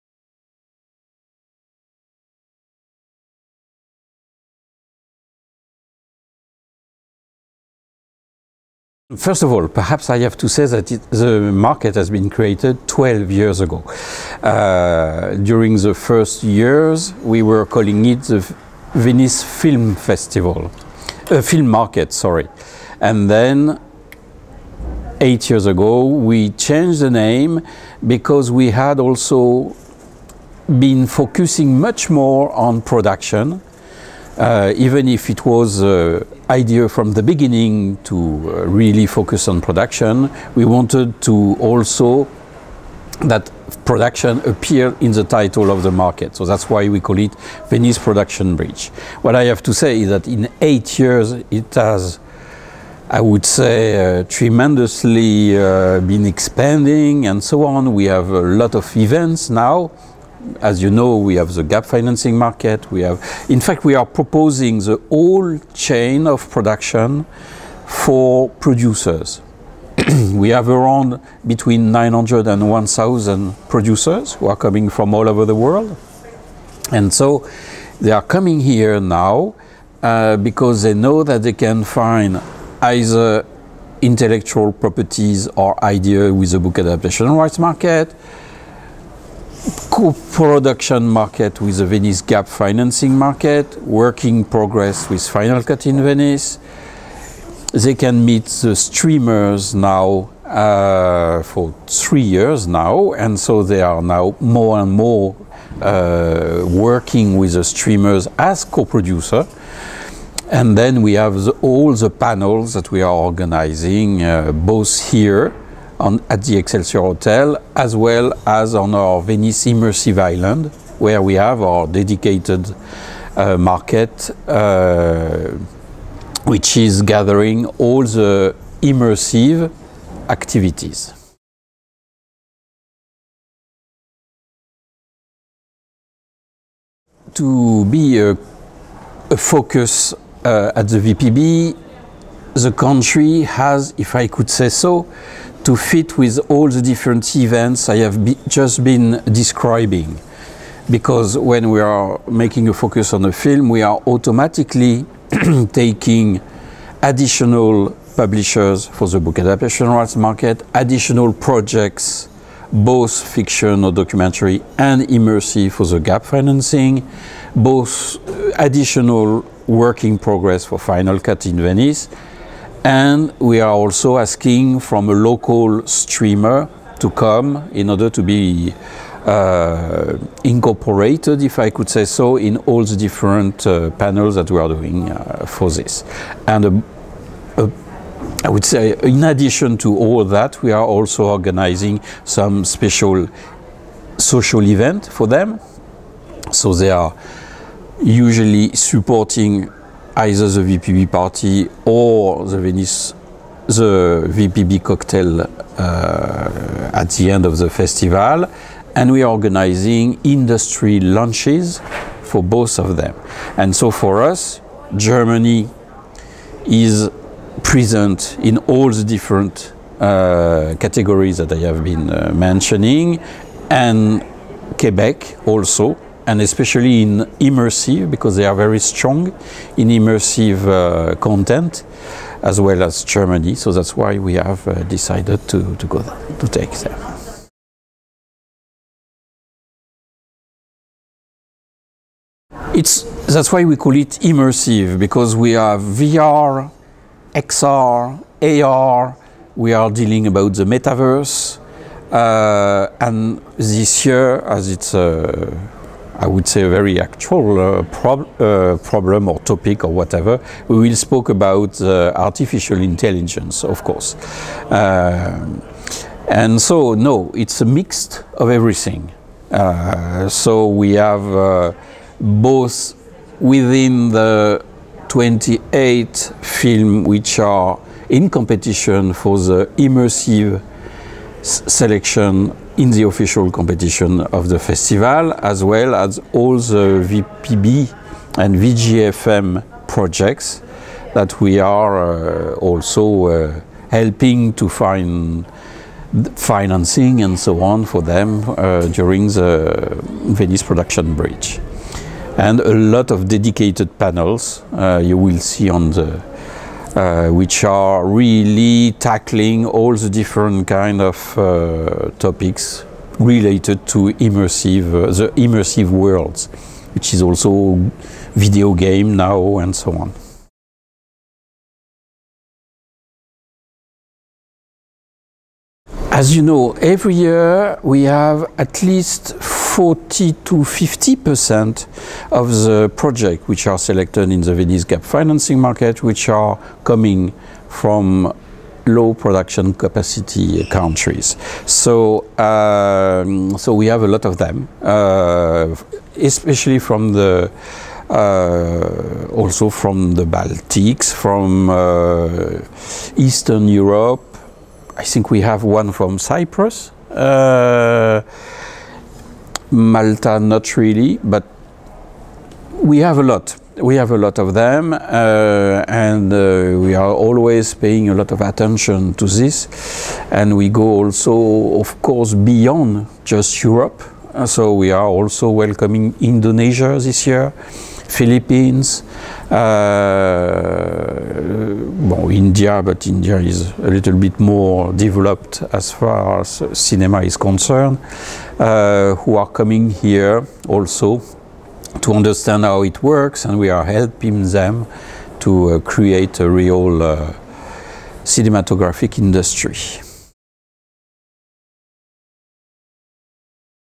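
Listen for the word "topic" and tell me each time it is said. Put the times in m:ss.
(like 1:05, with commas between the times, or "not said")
4:19, 5:12.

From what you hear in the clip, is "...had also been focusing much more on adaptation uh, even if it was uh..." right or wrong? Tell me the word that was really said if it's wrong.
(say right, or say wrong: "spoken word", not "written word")
wrong: "production", not "adaptation".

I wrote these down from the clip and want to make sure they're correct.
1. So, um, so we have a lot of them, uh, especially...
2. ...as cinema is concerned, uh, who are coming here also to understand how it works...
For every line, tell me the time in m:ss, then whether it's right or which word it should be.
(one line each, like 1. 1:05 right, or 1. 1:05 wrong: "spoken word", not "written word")
1. 5:41 right
2. 6:26 right.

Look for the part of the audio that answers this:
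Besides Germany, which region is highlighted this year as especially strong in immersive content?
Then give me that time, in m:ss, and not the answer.
3:44.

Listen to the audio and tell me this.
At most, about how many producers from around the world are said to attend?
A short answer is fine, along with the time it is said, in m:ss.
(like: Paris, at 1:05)
1,000, at 1:12.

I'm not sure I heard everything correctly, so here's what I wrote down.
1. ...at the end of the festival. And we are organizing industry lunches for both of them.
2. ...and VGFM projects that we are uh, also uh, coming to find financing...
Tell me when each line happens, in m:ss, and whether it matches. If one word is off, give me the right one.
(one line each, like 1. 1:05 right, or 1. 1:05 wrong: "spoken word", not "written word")
1. 3:26 right
2. 4:48 wrong: "helping", not "coming".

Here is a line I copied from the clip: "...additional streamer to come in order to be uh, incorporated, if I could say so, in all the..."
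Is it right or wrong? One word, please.
wrong.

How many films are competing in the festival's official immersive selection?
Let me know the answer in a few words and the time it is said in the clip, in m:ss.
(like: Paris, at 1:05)
28, at 4:35.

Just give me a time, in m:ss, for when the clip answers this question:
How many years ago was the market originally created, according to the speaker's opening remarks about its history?
0:12.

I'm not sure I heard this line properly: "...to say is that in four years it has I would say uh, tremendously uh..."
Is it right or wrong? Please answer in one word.
wrong.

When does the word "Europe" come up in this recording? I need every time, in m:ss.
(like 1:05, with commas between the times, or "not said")
5:53, 6:13.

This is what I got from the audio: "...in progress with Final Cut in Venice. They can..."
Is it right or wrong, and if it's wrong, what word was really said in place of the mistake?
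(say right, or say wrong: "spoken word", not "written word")
right.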